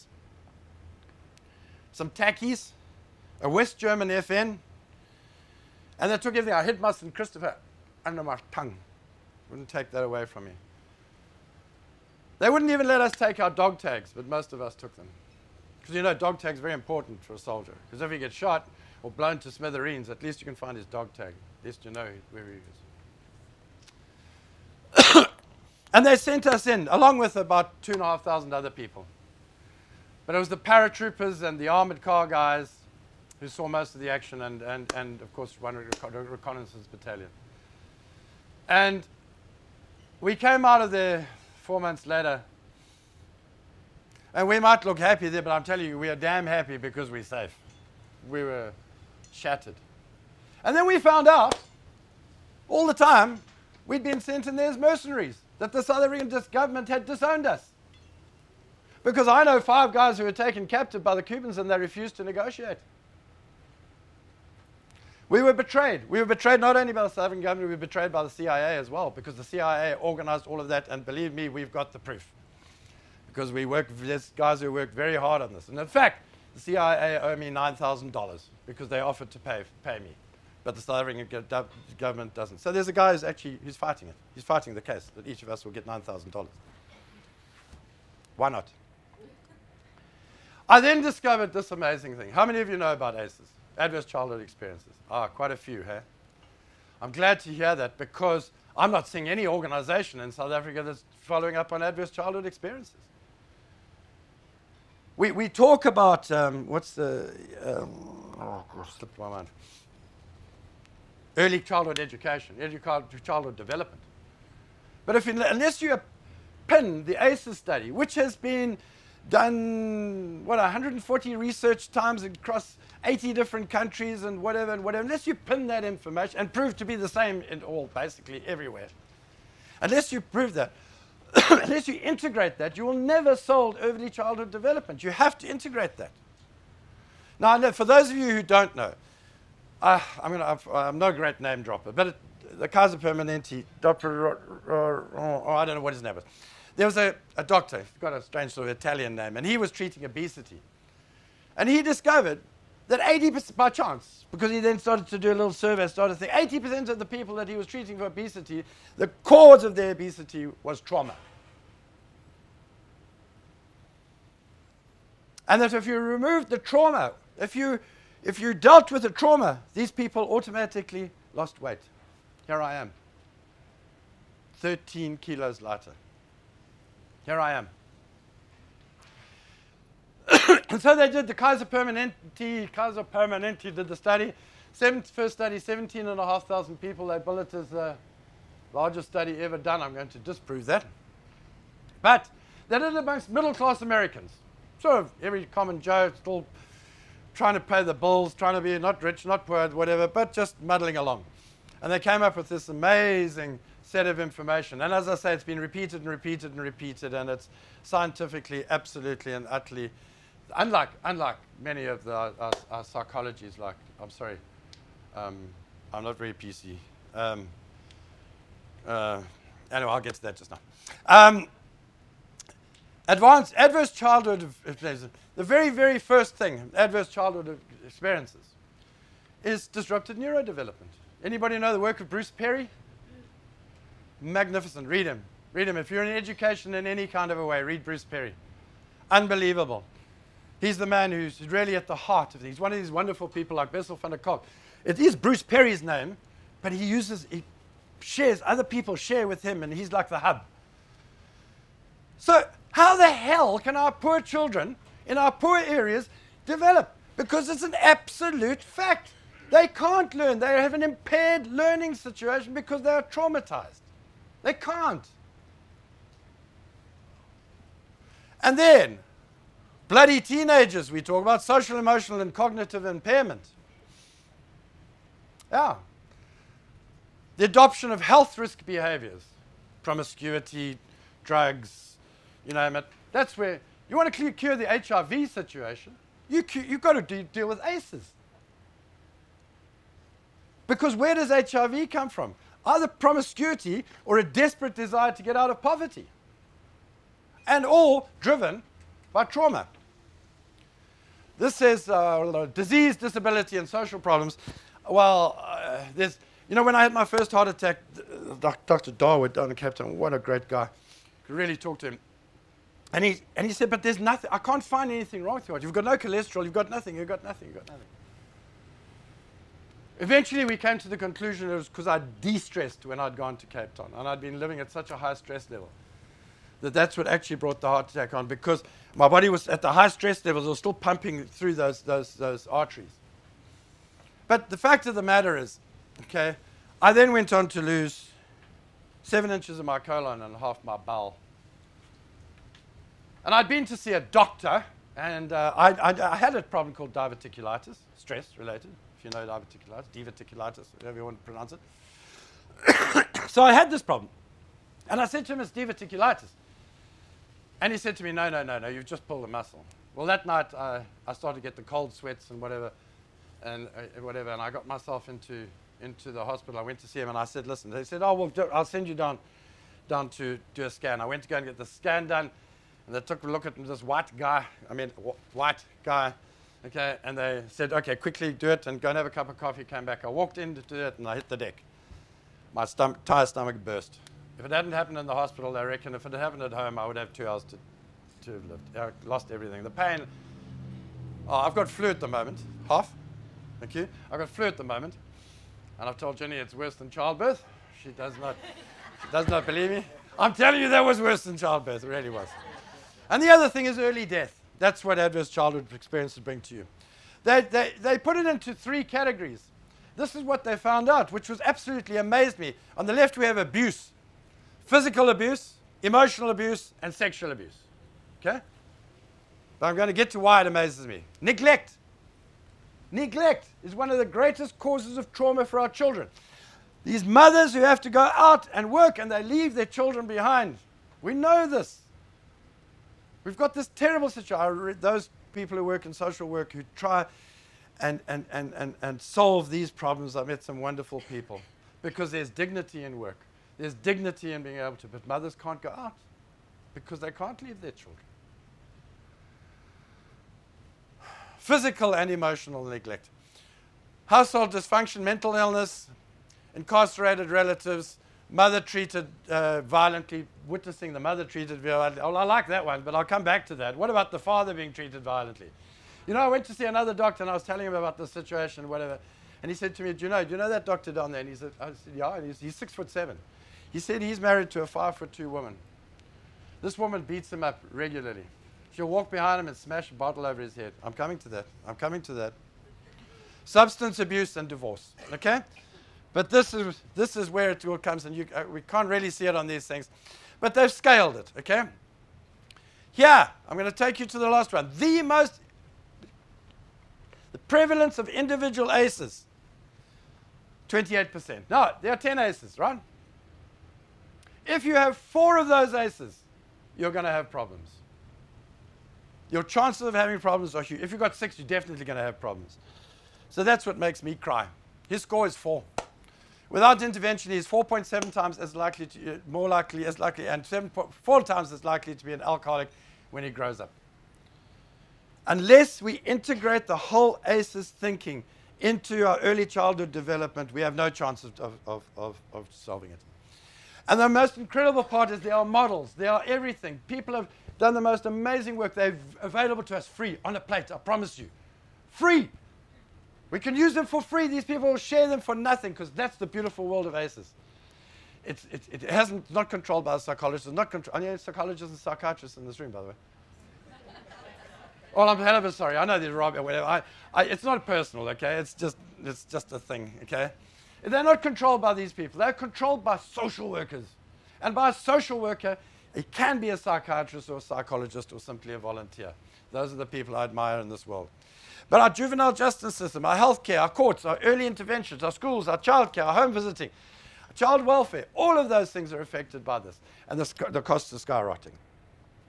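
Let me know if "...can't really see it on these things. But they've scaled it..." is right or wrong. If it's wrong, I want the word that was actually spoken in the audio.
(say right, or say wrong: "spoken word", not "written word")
right.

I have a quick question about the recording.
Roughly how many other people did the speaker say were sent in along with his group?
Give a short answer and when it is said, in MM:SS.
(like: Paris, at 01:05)
2,500, at 00:27.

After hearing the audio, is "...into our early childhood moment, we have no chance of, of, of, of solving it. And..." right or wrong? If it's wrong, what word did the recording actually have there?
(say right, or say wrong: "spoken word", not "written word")
wrong: "development", not "moment".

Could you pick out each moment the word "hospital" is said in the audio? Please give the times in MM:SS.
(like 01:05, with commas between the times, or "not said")
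06:06, 06:25.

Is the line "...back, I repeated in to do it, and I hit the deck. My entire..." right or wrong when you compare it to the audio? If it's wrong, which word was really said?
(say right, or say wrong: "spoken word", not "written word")
wrong: "walked", not "repeated".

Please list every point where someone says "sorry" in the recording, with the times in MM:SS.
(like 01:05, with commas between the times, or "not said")
03:34, 09:15.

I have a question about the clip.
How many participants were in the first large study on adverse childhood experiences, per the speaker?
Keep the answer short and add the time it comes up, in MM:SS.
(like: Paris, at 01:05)
17,500, at 03:05.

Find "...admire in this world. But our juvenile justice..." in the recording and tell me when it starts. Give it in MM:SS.
09:30.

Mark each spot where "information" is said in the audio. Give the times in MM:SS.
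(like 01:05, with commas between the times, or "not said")
02:05, 03:24.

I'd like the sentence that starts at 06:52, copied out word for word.
On the left, we have abuse physical abuse, emotional abuse, and sexual abuse.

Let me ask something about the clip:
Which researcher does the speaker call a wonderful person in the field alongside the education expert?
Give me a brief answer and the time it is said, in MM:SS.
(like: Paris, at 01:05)
Bessel van der Kolk, at 04:03.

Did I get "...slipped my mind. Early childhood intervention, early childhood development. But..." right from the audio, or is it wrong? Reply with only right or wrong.
wrong.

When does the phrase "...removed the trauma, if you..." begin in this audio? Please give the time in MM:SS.
02:45.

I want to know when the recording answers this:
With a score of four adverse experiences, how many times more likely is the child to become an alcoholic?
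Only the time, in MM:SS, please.
08:40.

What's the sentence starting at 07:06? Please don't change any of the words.
These mothers who have to go out and work and they leave their children behind.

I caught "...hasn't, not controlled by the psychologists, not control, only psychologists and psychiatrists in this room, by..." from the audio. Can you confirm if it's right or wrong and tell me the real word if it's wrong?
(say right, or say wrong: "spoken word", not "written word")
right.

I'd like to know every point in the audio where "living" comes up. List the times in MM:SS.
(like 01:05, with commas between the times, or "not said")
05:24.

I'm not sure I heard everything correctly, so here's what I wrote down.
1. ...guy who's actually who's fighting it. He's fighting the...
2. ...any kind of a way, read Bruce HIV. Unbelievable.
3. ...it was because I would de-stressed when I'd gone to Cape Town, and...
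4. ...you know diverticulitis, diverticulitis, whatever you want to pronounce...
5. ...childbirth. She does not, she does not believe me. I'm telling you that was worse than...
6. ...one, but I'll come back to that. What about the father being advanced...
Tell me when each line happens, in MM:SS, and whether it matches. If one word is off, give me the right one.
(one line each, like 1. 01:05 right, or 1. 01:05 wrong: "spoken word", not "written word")
1. 01:22 right
2. 03:56 wrong: "Perry", not "HIV"
3. 05:21 right
4. 05:49 right
5. 06:36 right
6. 07:42 wrong: "treated", not "advanced".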